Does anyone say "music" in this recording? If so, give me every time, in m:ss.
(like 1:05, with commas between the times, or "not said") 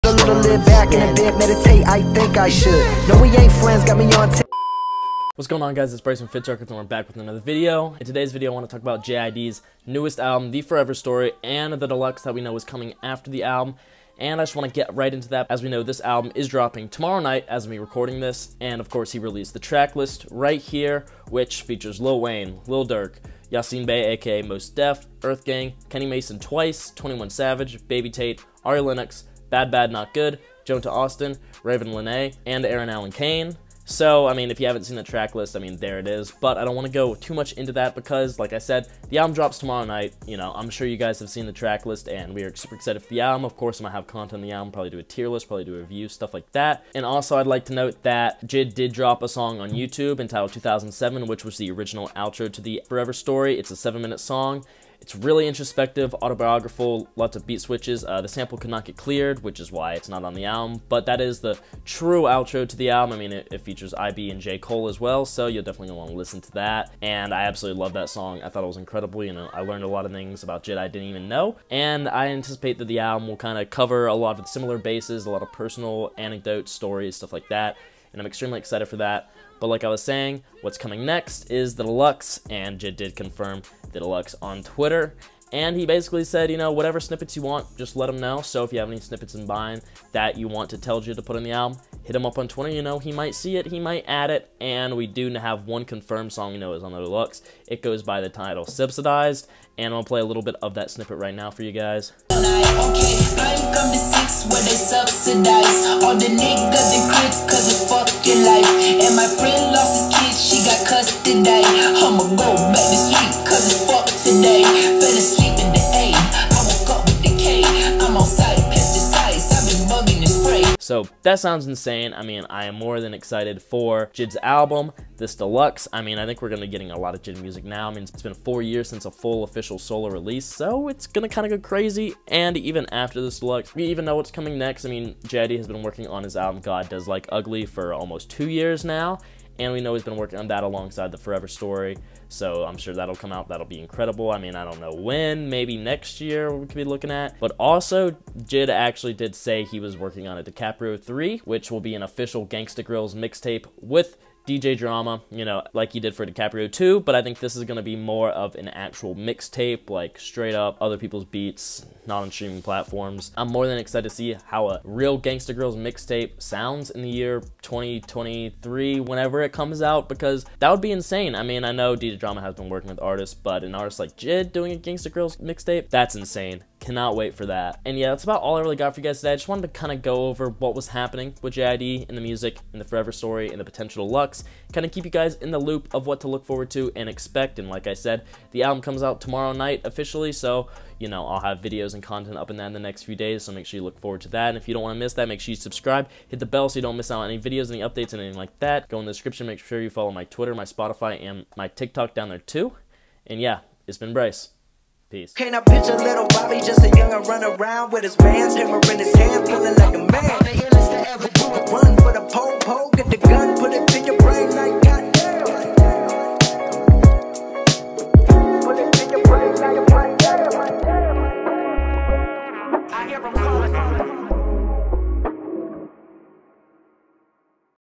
2:07, 3:02.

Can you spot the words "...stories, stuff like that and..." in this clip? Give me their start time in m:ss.
1:16.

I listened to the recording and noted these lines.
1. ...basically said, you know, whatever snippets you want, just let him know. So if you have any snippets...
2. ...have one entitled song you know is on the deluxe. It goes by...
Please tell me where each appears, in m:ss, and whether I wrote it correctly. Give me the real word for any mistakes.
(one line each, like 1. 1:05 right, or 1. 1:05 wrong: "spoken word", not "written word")
1. 1:25 right
2. 1:35 wrong: "confirmed", not "entitled".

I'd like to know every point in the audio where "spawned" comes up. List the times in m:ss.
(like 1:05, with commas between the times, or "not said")
not said.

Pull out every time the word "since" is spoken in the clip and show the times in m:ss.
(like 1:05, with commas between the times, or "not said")
2:08.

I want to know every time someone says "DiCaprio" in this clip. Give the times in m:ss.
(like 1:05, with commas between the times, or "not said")
2:30, 2:36.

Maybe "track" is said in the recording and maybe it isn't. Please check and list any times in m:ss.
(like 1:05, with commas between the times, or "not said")
0:19, 0:35, 0:41.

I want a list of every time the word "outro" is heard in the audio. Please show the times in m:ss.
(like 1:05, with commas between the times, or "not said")
0:52, 1:02.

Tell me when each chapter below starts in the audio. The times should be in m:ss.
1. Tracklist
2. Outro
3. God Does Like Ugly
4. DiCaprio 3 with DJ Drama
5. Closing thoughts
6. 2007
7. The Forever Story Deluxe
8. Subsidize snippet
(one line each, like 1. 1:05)
1. 0:19
2. 3:15
3. 2:13
4. 2:27
5. 2:58
6. 0:48
7. 1:19
8. 1:42.